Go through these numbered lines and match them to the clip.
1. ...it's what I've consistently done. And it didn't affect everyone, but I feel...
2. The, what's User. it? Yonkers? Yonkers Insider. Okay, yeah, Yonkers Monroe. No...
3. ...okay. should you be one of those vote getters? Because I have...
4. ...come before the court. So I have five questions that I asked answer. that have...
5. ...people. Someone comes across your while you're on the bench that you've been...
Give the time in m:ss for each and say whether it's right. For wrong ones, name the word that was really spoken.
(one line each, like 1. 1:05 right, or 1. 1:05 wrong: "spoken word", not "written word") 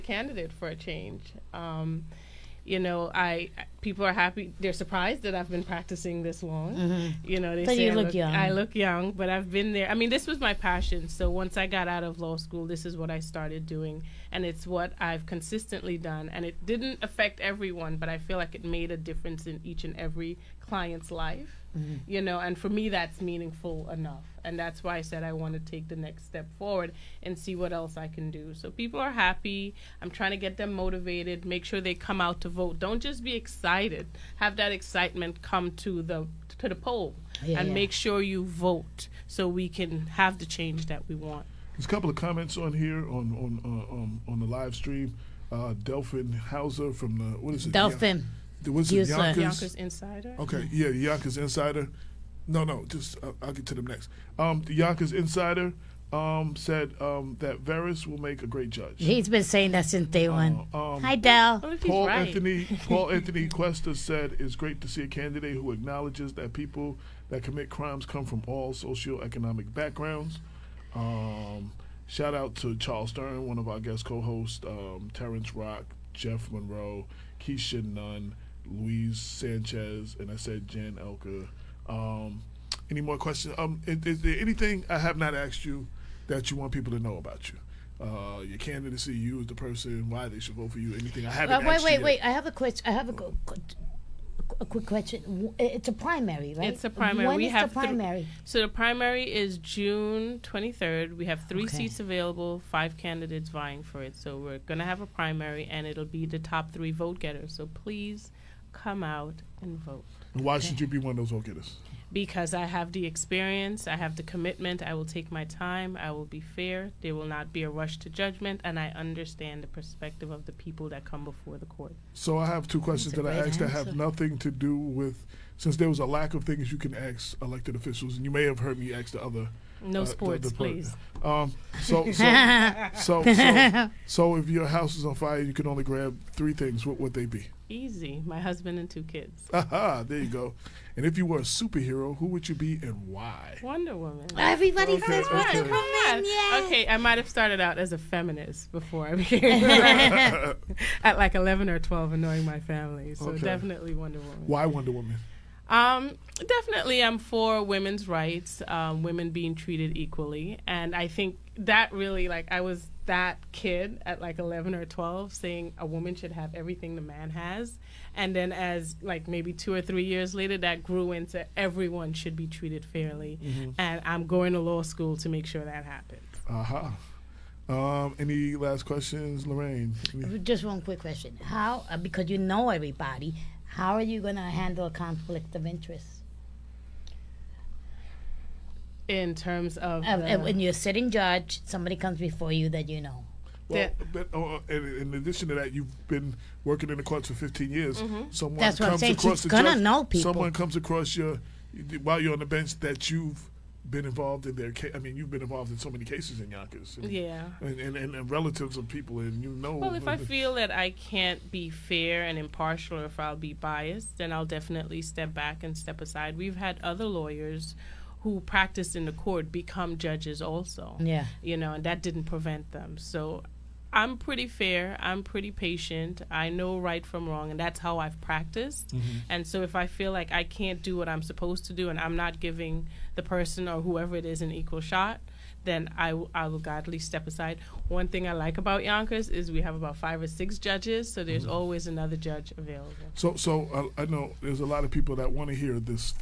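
1. 0:14 right
2. 0:48 wrong: "Insider", not "Monroe"
3. 1:50 right
4. 2:01 wrong: "two", not "five"
5. 3:20 right.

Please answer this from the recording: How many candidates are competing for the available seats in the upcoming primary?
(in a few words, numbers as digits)
5.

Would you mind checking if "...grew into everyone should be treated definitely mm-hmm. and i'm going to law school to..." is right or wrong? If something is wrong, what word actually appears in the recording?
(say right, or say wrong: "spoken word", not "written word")
wrong: "fairly", not "definitely".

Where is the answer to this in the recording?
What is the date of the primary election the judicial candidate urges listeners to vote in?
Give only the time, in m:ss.
1:39.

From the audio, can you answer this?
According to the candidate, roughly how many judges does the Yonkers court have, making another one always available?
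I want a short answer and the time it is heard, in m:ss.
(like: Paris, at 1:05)
5 or 6, at 3:59.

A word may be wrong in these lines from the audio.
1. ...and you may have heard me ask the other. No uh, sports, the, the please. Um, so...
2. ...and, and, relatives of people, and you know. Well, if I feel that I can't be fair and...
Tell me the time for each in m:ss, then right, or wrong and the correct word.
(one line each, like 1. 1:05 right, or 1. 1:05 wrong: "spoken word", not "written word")
1. 2:08 right
2. 3:27 right.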